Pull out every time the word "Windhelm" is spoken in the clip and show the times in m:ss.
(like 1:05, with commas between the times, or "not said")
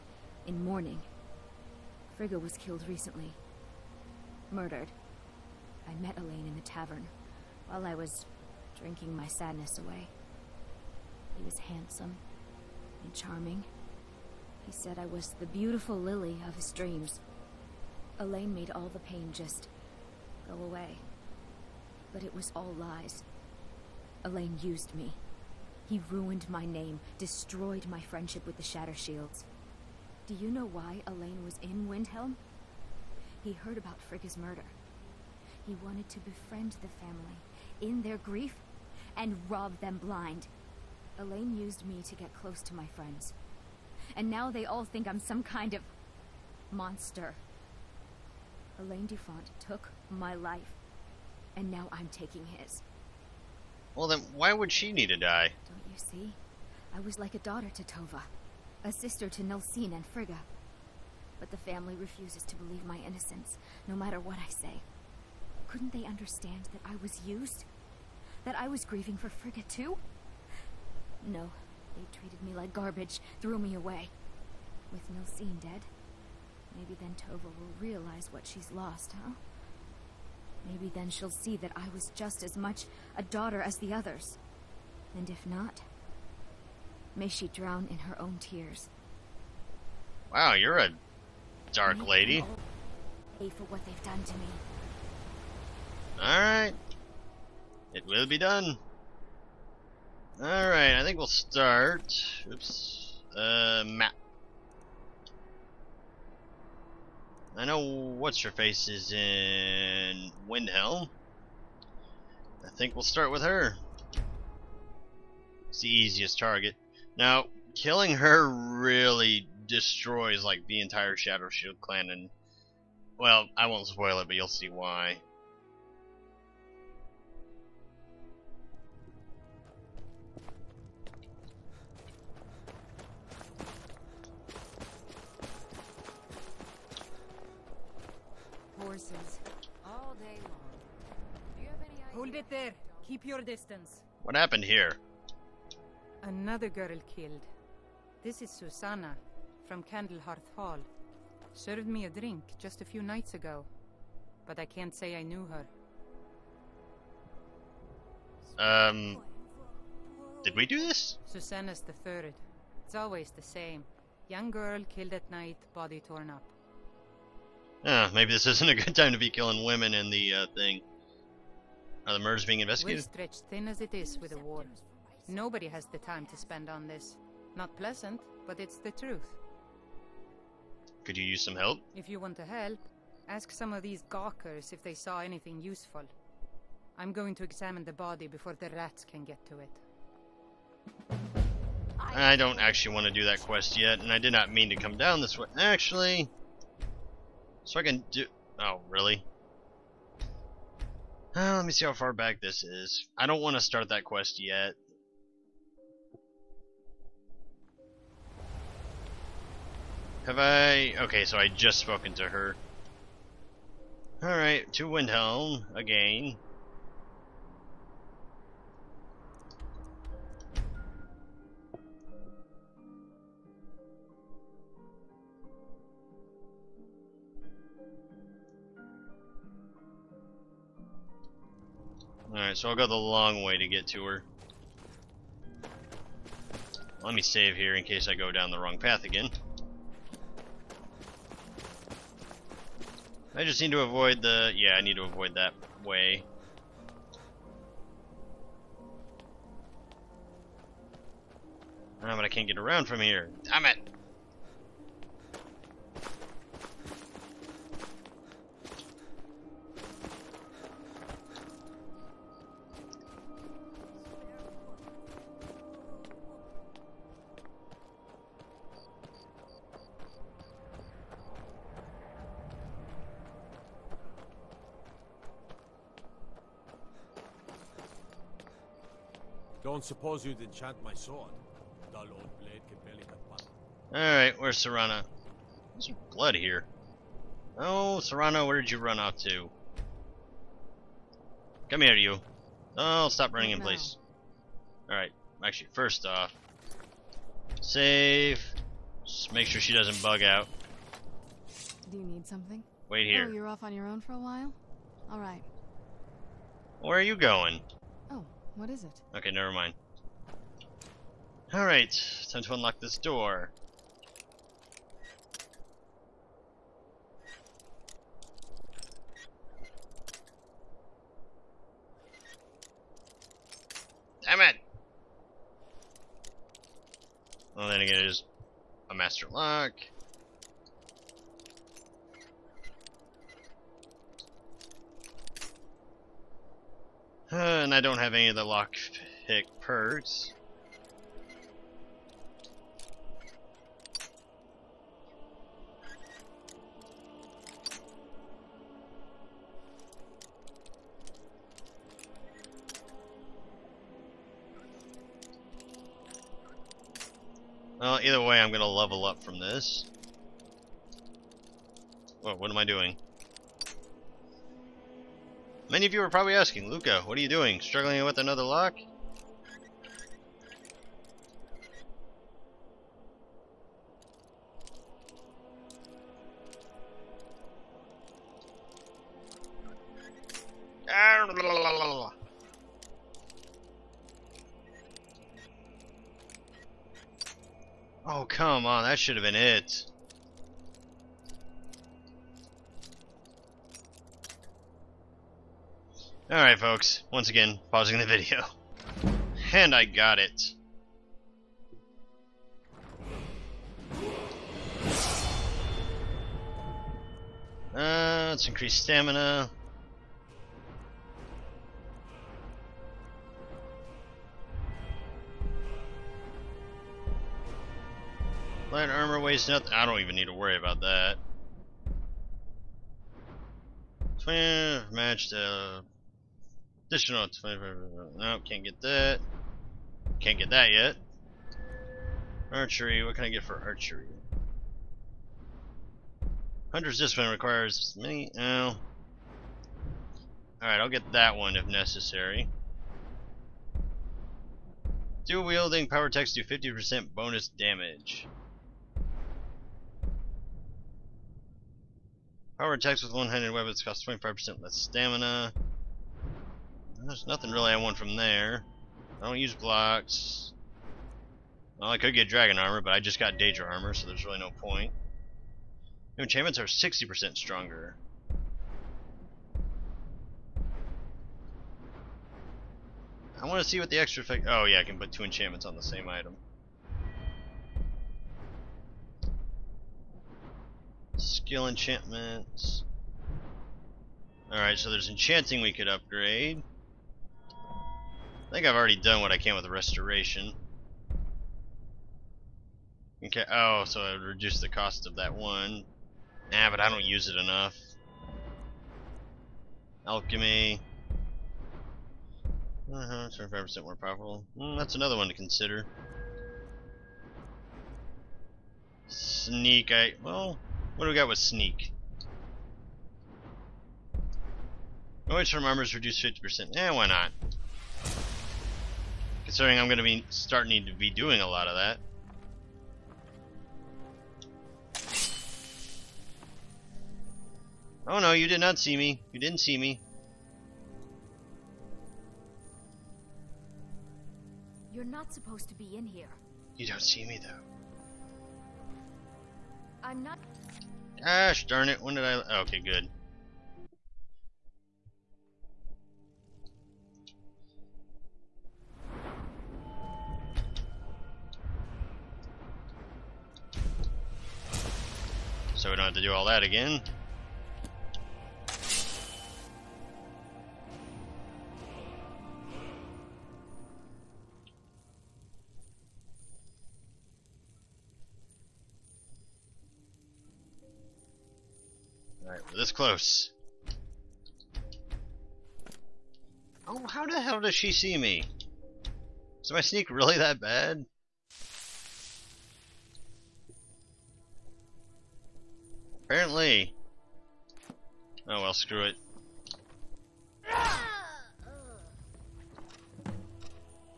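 0:31, 1:50, 3:34.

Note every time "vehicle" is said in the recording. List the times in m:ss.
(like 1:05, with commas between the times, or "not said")
not said.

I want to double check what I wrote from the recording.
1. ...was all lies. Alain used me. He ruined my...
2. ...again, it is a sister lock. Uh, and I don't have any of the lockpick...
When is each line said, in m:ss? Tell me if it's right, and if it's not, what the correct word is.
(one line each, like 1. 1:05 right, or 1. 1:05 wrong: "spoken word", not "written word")
1. 0:22 right
2. 5:27 wrong: "master", not "sister".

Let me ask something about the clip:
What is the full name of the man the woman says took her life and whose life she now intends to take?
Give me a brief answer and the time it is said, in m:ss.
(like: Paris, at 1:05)
Alain Dufont, at 0:48.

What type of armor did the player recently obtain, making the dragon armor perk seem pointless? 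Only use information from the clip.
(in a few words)
Daedra armor.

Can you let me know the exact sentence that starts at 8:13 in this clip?
Okay, oh, so I would reduce the cost of that one.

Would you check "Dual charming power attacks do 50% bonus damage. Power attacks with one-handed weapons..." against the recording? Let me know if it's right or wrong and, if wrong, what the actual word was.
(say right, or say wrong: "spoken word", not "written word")
wrong: "wielding", not "charming".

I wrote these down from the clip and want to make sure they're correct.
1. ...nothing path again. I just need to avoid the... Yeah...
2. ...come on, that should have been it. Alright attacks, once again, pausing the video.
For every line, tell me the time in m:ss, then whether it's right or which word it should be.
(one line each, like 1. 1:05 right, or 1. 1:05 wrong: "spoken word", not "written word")
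1. 3:58 wrong: "wrong", not "nothing"
2. 6:28 wrong: "folks", not "attacks".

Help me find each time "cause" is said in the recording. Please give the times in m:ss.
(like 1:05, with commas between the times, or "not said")
not said.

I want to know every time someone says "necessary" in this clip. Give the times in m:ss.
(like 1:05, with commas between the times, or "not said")
7:21.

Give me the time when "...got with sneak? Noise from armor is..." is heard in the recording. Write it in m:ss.
8:31.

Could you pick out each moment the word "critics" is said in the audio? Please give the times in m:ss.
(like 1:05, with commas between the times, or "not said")
not said.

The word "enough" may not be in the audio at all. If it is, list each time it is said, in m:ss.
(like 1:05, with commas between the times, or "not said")
8:17.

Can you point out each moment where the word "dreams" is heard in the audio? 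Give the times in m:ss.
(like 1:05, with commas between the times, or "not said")
0:16.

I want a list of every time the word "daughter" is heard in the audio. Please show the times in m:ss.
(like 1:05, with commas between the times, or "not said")
0:57, 1:23.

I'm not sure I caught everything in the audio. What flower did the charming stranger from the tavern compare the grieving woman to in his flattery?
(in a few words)
Lily.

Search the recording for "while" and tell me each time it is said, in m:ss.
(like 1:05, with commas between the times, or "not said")
0:07, 5:04.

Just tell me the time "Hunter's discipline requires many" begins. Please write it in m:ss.
7:16.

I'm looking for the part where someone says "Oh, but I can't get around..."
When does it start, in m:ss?
4:12.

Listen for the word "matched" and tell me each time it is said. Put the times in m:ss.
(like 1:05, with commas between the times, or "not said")
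7:04.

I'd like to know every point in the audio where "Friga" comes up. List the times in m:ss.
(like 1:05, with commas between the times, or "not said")
0:02, 0:34, 1:00, 1:09.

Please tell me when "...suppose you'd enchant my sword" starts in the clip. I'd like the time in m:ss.
4:39.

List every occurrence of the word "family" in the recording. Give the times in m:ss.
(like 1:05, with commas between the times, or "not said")
0:36, 1:01.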